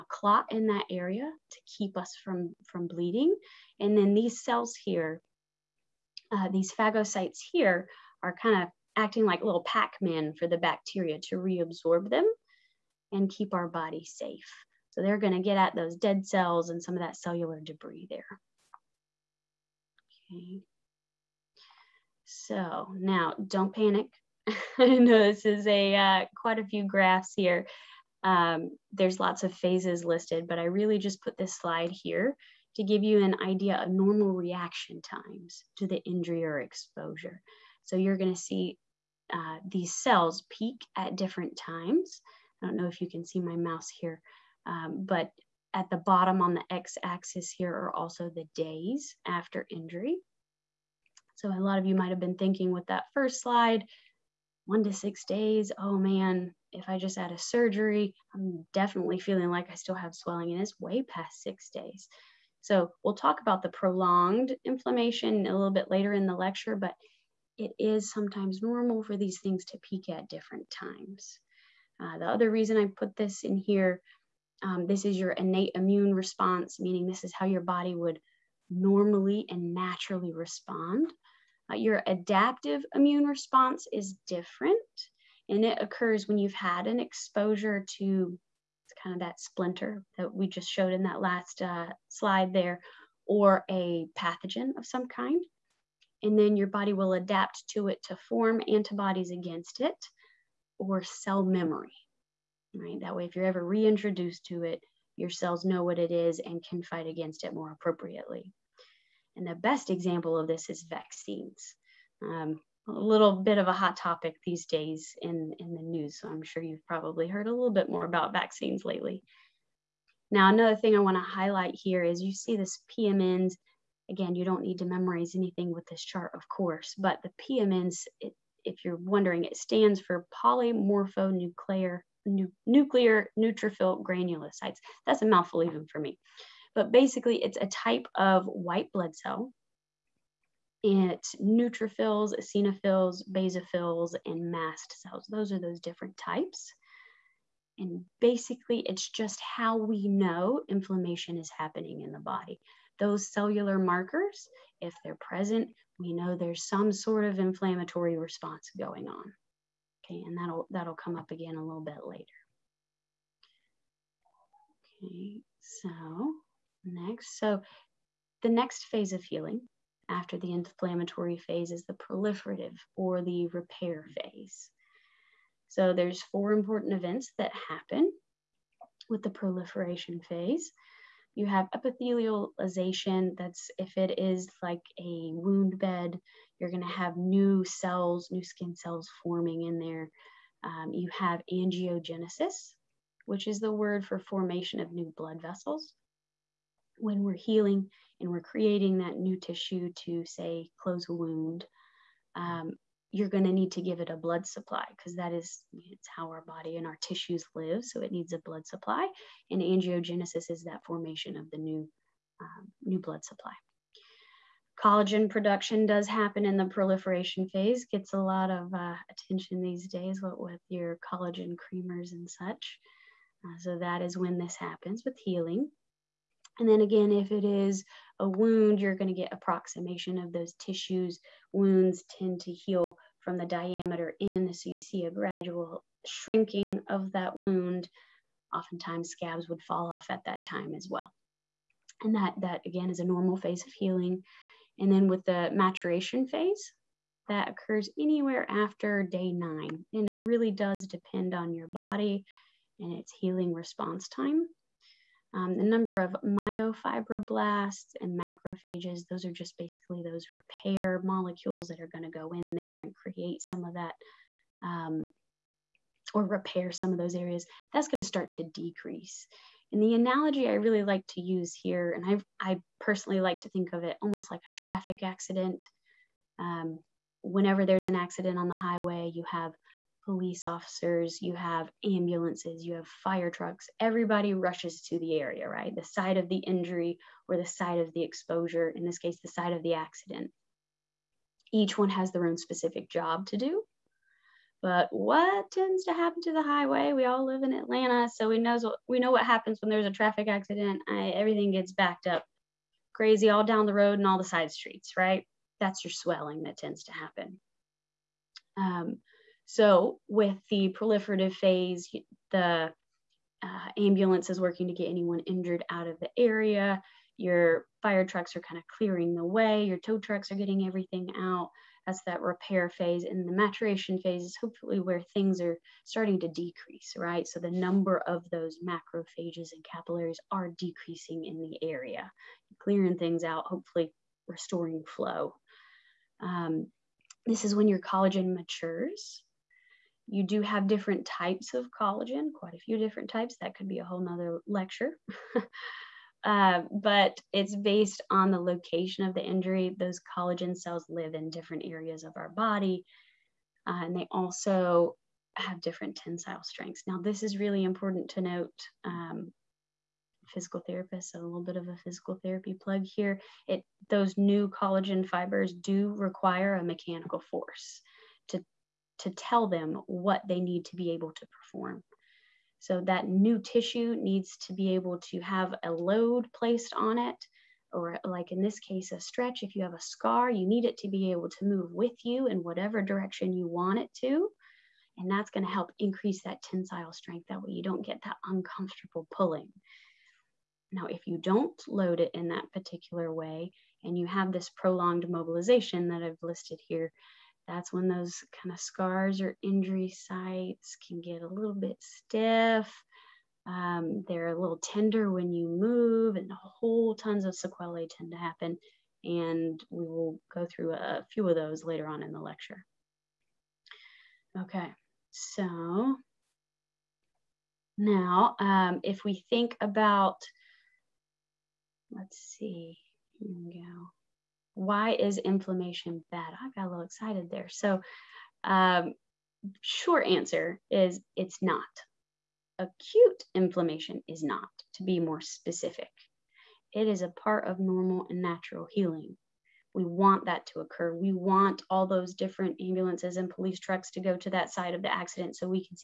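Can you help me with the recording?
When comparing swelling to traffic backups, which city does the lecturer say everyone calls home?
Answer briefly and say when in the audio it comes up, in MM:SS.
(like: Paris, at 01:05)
Atlanta, at 04:57.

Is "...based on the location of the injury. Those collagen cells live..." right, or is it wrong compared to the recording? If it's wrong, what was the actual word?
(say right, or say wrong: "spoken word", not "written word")
right.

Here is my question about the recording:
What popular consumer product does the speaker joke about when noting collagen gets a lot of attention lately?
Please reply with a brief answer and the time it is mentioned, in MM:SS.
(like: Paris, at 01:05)
collagen creamers, at 03:41.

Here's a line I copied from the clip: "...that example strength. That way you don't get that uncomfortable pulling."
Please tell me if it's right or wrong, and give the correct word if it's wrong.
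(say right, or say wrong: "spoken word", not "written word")
wrong: "tensile", not "example".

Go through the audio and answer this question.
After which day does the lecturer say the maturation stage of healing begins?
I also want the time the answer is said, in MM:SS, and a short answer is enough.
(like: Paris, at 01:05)
day 9, at 04:08.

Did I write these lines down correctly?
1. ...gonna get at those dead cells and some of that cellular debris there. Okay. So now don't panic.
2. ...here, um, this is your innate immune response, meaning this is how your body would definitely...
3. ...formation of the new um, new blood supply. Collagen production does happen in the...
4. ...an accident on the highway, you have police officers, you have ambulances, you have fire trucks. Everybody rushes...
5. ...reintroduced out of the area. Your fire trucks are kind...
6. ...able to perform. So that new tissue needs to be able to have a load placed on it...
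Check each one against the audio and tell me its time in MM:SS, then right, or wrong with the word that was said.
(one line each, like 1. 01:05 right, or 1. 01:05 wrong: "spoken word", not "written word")
1. 00:15 right
2. 01:13 wrong: "normally", not "definitely"
3. 03:30 right
4. 04:37 right
5. 05:15 wrong: "injured", not "reintroduced"
6. 06:10 right.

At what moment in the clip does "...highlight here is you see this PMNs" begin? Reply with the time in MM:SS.
02:01.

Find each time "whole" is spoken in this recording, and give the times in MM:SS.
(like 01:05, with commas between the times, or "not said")
05:43, 06:46.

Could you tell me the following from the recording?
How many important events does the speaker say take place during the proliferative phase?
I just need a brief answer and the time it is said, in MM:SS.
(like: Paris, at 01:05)
4, at 02:56.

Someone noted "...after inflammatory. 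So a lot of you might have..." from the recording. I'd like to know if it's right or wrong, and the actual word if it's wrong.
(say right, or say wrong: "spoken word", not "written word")
wrong: "injury", not "inflammatory".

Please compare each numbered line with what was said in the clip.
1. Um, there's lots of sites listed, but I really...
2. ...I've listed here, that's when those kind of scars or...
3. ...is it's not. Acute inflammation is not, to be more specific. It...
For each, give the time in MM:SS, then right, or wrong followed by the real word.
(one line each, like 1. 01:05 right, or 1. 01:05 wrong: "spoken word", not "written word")
1. 00:28 wrong: "phases", not "sites"
2. 06:36 right
3. 07:10 right.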